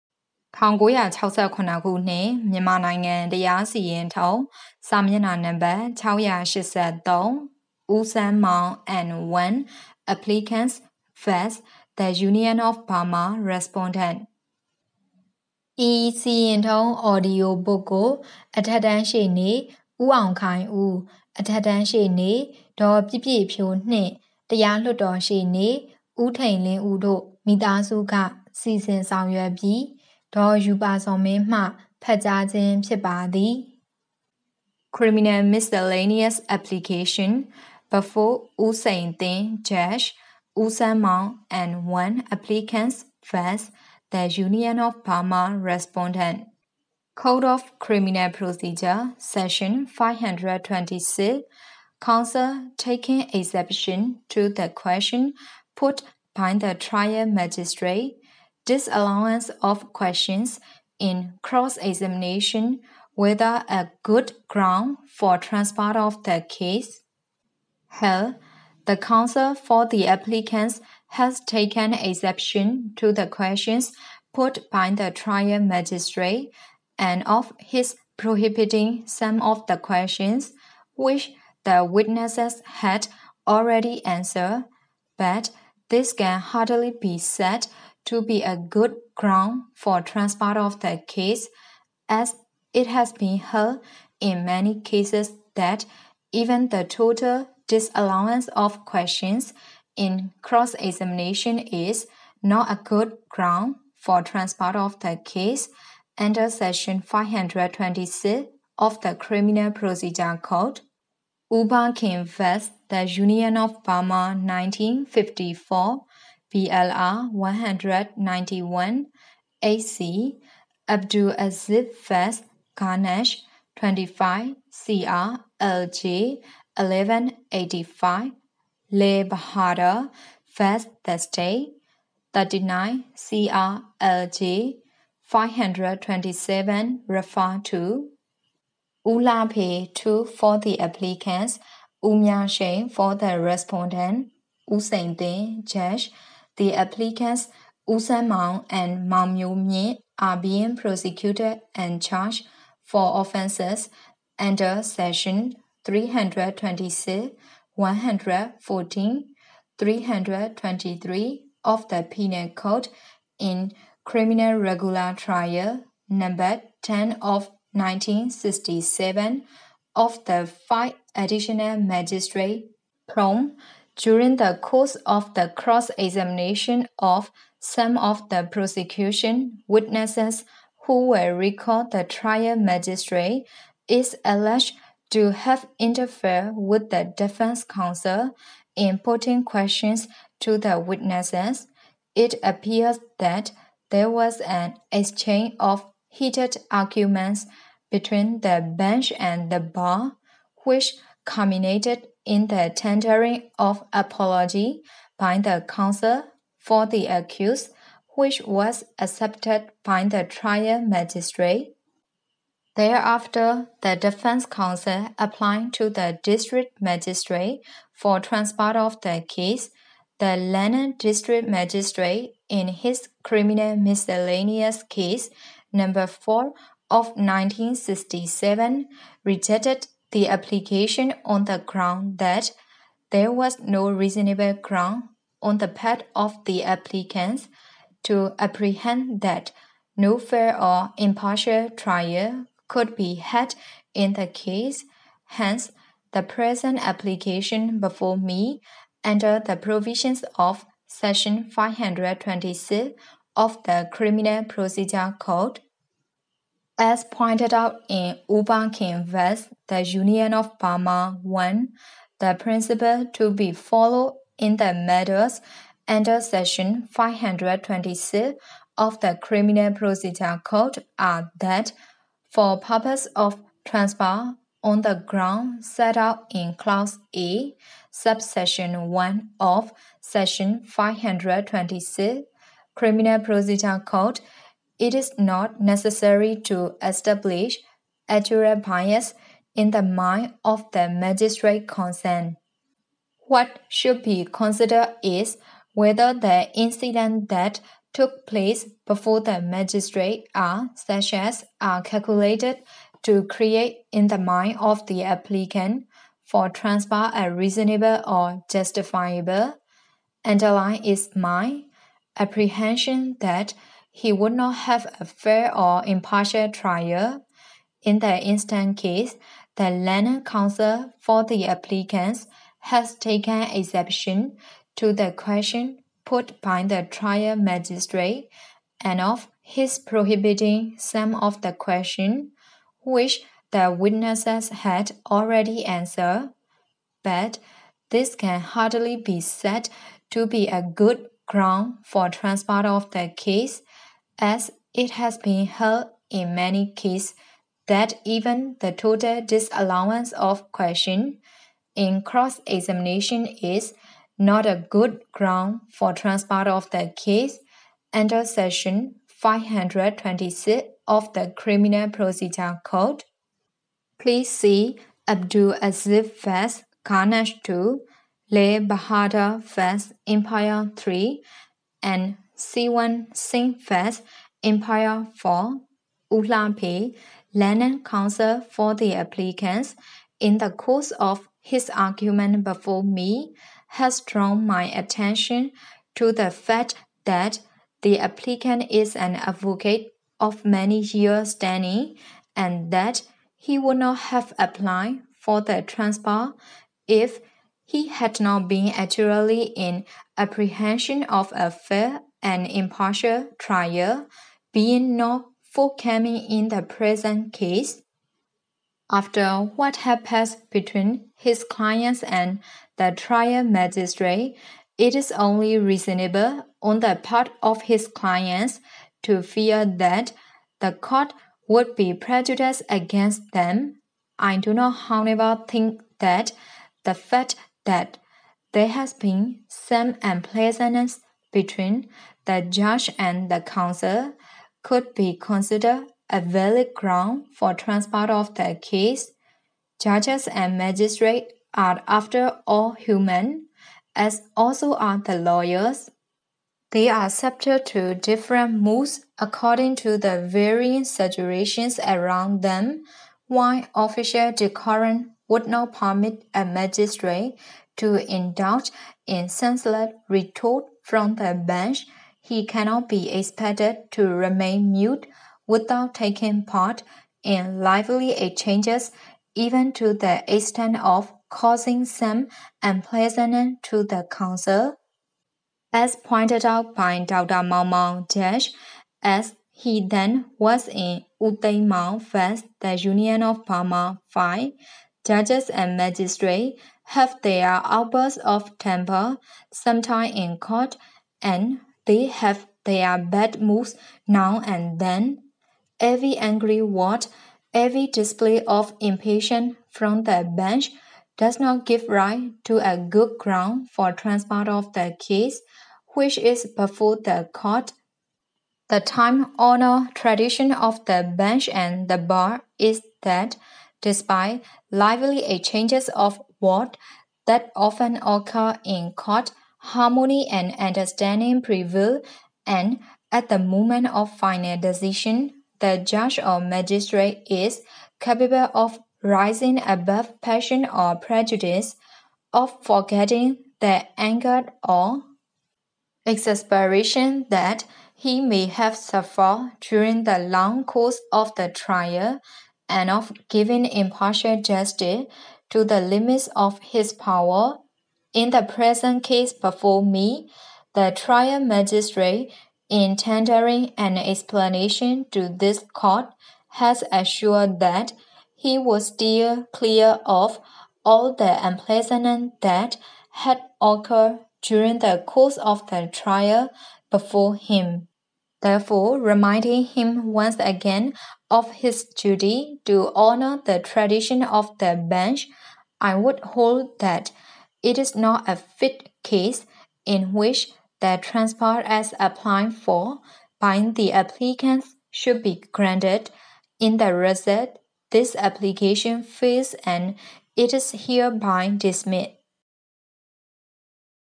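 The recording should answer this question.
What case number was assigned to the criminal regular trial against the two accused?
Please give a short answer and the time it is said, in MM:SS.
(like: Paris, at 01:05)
10 of 1967, at 02:46.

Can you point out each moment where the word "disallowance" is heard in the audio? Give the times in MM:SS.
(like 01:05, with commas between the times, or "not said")
00:58, 01:37, 05:49.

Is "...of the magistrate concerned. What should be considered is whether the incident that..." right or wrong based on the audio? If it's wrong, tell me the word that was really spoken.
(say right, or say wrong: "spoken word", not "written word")
right.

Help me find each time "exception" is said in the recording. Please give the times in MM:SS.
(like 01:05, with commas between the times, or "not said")
00:53, 01:11, 05:23.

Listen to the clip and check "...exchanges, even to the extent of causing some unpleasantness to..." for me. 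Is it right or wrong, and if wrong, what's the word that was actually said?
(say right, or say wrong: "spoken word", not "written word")
right.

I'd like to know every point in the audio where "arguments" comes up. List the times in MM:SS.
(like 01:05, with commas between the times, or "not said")
03:16, 06:21.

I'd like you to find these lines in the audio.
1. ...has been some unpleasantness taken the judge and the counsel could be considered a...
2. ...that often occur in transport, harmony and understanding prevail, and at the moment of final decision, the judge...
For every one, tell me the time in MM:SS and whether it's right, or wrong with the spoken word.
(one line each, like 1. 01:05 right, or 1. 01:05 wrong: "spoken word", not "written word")
1. 07:08 wrong: "between", not "taken"
2. 08:37 wrong: "court", not "transport".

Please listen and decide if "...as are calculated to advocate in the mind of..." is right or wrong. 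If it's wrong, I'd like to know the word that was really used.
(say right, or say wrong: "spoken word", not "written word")
wrong: "create", not "advocate".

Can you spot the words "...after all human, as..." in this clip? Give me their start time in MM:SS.
07:21.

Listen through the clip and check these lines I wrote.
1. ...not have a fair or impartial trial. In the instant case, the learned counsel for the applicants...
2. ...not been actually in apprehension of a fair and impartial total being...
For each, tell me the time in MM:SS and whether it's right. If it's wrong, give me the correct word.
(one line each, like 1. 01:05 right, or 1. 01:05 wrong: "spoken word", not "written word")
1. 05:14 right
2. 06:38 wrong: "trial", not "total".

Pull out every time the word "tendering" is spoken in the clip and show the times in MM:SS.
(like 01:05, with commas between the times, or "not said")
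03:22, 09:12.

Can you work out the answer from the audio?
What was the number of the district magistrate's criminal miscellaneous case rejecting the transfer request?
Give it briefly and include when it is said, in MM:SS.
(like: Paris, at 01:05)
4 of 1967, at 03:45.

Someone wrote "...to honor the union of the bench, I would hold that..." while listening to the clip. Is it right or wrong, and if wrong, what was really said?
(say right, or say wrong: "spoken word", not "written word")
wrong: "tradition", not "union".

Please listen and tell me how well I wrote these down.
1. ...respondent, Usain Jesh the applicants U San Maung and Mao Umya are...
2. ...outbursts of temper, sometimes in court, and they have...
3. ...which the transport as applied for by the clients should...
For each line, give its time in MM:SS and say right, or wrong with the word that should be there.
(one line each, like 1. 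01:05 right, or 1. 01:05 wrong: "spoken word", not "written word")
1. 02:23 wrong: "Mye", not "Umya"
2. 08:07 right
3. 09:40 wrong: "applicants", not "clients".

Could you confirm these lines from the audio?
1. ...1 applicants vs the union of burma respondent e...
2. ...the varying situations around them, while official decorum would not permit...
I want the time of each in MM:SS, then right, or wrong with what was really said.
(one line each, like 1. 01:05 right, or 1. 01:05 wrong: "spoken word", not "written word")
1. 00:09 right
2. 07:29 right.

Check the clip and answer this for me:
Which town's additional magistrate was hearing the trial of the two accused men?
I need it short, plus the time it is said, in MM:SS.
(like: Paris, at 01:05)
Prome, at 02:53.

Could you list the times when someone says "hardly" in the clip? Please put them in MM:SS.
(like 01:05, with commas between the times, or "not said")
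01:26, 05:38.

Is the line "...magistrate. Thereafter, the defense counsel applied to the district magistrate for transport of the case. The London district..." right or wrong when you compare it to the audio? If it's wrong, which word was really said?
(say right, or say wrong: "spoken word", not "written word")
right.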